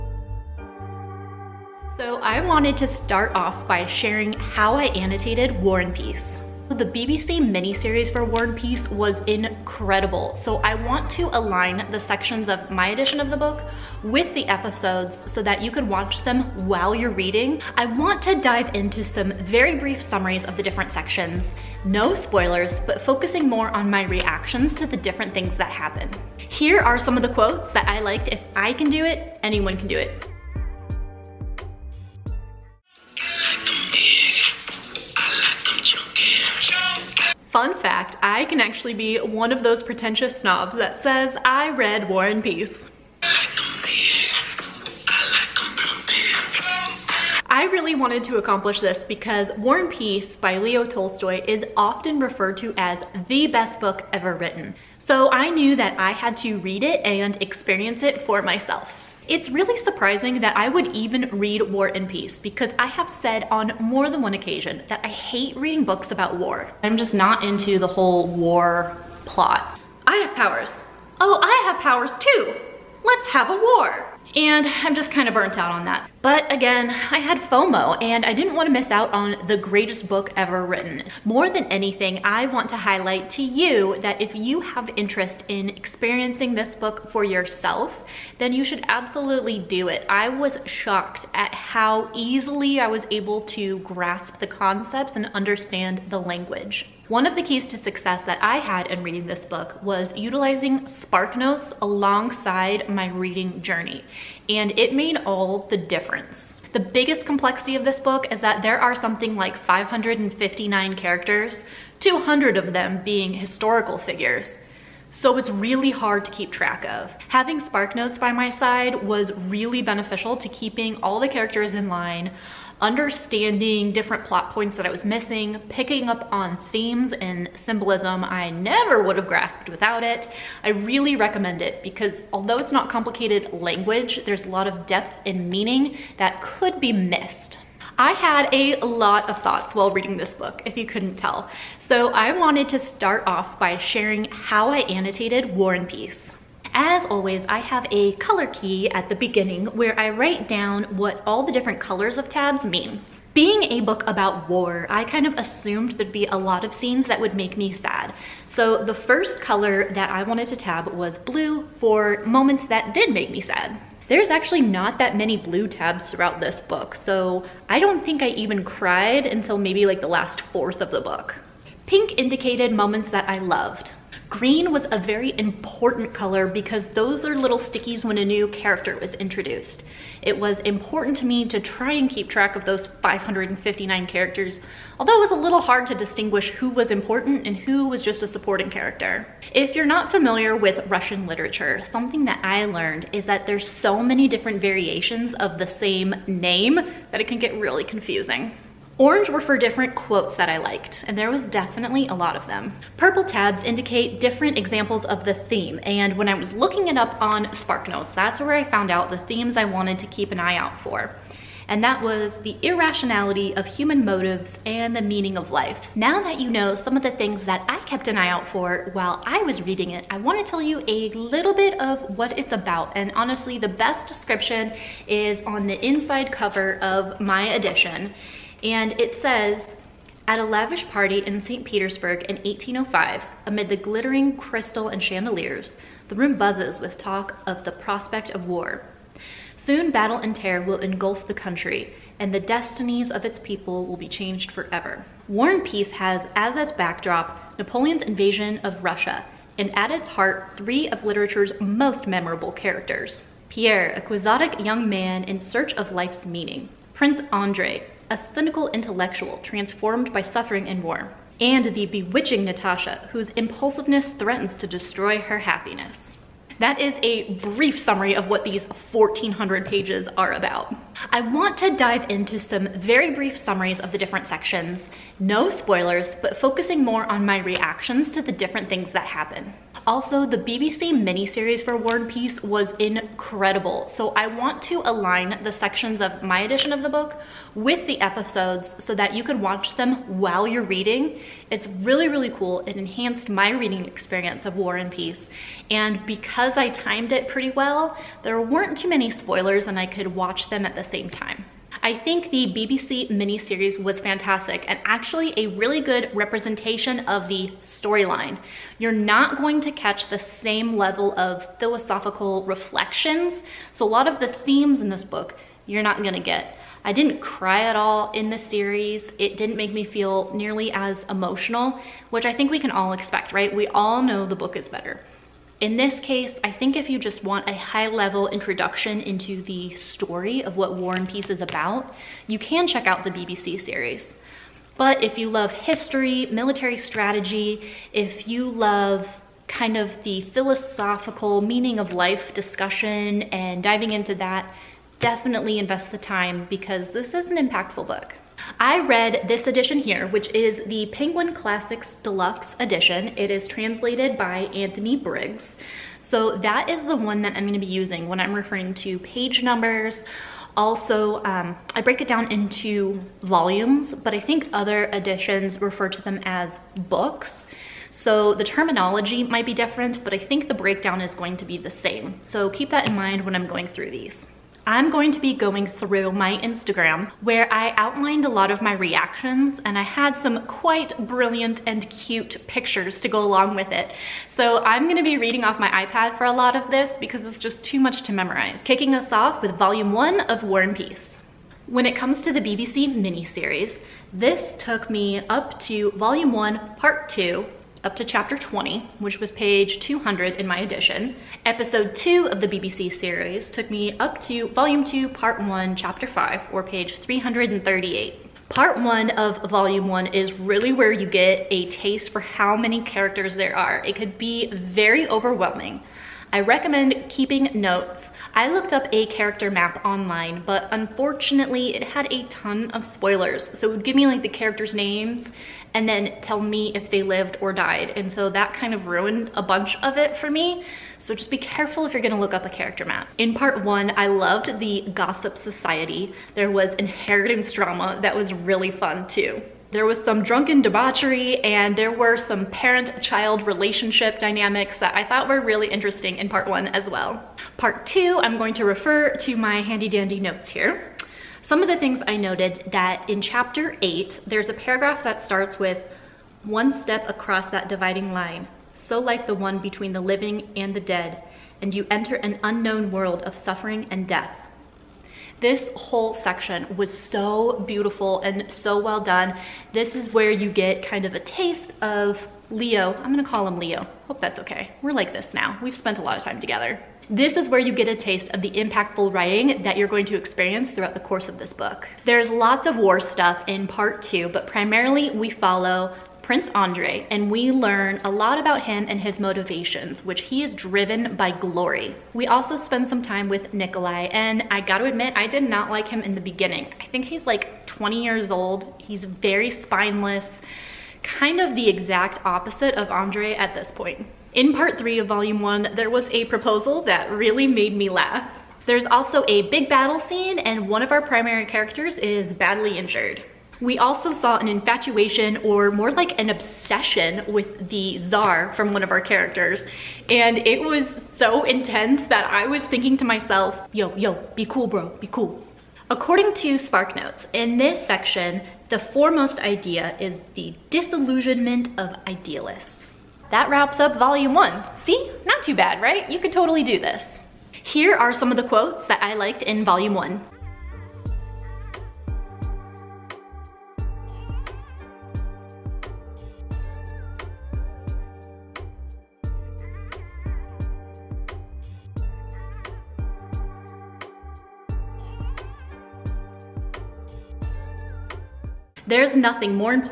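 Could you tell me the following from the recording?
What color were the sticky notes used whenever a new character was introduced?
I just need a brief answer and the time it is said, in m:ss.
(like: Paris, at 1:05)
Green, at 2:54.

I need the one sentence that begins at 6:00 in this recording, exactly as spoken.
Also, um, I break it down into volumes, but I think other editions refer to them as books.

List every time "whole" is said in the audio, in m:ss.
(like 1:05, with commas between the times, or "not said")
1:07, 7:45.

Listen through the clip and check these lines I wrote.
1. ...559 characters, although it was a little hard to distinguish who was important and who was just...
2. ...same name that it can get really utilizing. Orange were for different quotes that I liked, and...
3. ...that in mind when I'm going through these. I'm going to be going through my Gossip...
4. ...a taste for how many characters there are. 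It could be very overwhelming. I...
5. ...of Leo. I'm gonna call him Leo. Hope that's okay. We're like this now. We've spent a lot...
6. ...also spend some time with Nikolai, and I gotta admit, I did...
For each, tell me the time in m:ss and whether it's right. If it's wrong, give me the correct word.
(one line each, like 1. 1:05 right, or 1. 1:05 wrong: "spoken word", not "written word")
1. 3:03 right
2. 3:15 wrong: "confusing", not "utilizing"
3. 6:12 wrong: "Instagram", not "Gossip"
4. 6:51 right
5. 7:51 right
6. 8:12 right.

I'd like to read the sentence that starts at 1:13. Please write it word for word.
Let's have a war and I'm just kind of burnt out on that.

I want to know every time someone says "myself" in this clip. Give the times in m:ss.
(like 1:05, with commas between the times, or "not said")
0:58, 8:43.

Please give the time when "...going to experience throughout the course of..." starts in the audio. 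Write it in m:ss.
7:59.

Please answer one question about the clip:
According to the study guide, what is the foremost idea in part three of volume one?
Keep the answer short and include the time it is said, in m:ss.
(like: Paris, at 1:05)
Disillusionment of idealists, at 8:50.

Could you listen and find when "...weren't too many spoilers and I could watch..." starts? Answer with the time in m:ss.
4:58.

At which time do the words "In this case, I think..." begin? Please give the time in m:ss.
5:25.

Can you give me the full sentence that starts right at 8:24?
In part three of volume one, there was a proposal that really made me laugh.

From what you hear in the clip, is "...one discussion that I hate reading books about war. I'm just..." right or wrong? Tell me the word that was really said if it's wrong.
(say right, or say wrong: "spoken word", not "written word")
wrong: "occasion", not "discussion".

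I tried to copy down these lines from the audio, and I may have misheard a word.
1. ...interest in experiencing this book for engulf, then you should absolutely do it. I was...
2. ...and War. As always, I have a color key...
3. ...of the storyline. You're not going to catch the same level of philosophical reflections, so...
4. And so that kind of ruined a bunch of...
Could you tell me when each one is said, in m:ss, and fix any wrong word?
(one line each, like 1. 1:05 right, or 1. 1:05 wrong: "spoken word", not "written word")
1. 1:24 wrong: "yourself", not "engulf"
2. 2:25 wrong: "Peace", not "War"
3. 5:07 right
4. 7:07 right.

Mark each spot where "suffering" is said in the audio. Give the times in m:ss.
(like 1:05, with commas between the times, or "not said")
4:20, 7:43.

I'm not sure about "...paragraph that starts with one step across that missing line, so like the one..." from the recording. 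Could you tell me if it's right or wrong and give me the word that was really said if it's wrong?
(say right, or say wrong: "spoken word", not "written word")
wrong: "dividing", not "missing".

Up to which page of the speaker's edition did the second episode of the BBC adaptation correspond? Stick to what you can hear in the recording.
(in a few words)
338.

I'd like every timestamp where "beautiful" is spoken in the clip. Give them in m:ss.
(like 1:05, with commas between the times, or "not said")
7:47.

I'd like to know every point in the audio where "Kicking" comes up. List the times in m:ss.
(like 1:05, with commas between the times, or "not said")
6:28.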